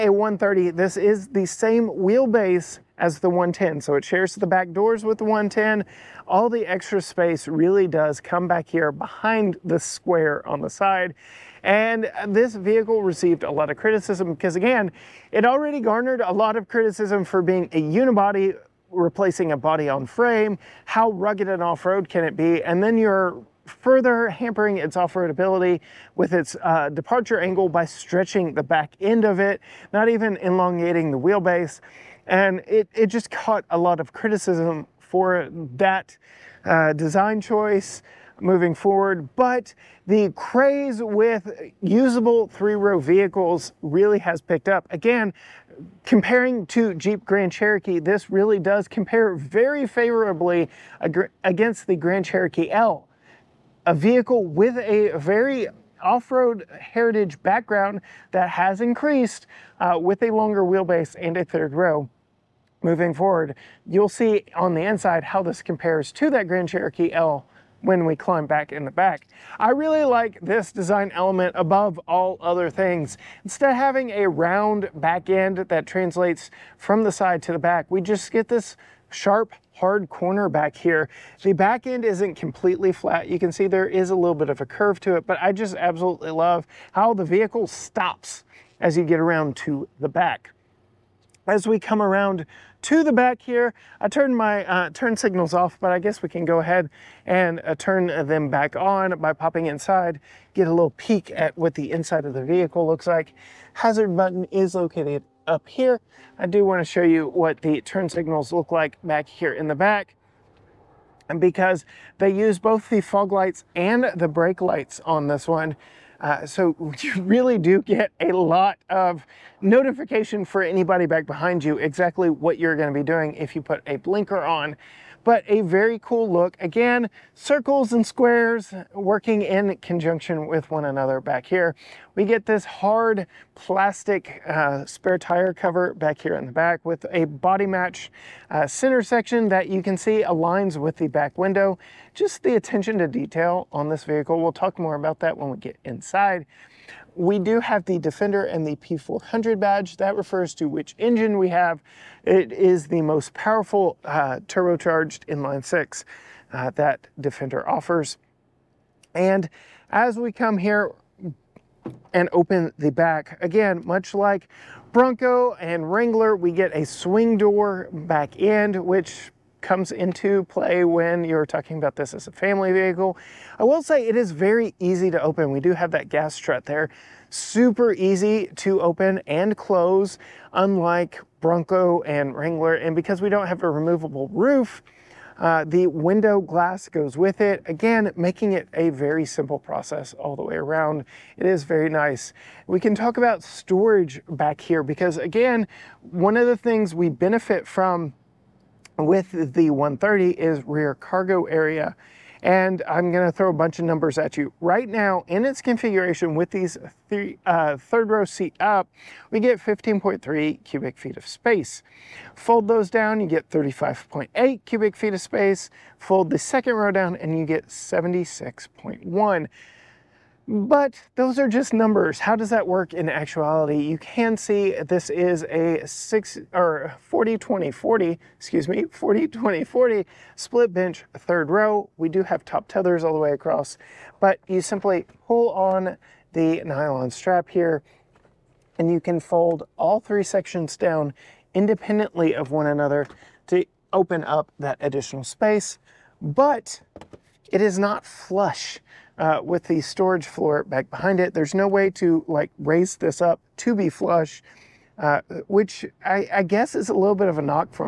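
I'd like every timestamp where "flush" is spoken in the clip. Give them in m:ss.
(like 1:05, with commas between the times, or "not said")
4:08, 4:13.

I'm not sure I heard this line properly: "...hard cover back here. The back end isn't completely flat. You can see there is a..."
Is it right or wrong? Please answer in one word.
wrong.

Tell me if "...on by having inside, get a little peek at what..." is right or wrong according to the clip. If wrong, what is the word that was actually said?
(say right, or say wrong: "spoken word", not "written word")
wrong: "popping", not "having".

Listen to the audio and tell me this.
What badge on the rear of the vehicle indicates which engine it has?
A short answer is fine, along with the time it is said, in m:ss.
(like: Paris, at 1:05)
P400, at 2:28.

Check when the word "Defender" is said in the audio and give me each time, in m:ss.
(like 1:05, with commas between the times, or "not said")
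2:27, 2:37.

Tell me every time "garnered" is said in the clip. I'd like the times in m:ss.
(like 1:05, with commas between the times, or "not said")
0:15.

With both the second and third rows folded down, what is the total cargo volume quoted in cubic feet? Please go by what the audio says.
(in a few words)
76.1.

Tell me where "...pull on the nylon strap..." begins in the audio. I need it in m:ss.
3:55.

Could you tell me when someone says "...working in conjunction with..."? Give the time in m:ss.
2:08.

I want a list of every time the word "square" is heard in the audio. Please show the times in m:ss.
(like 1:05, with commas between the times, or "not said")
0:09, 2:08.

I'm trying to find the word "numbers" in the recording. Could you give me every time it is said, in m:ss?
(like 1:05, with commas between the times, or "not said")
3:23, 3:41.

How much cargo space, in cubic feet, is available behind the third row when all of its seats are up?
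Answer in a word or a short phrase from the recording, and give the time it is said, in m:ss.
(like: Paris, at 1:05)
15.3 cubic feet, at 3:29.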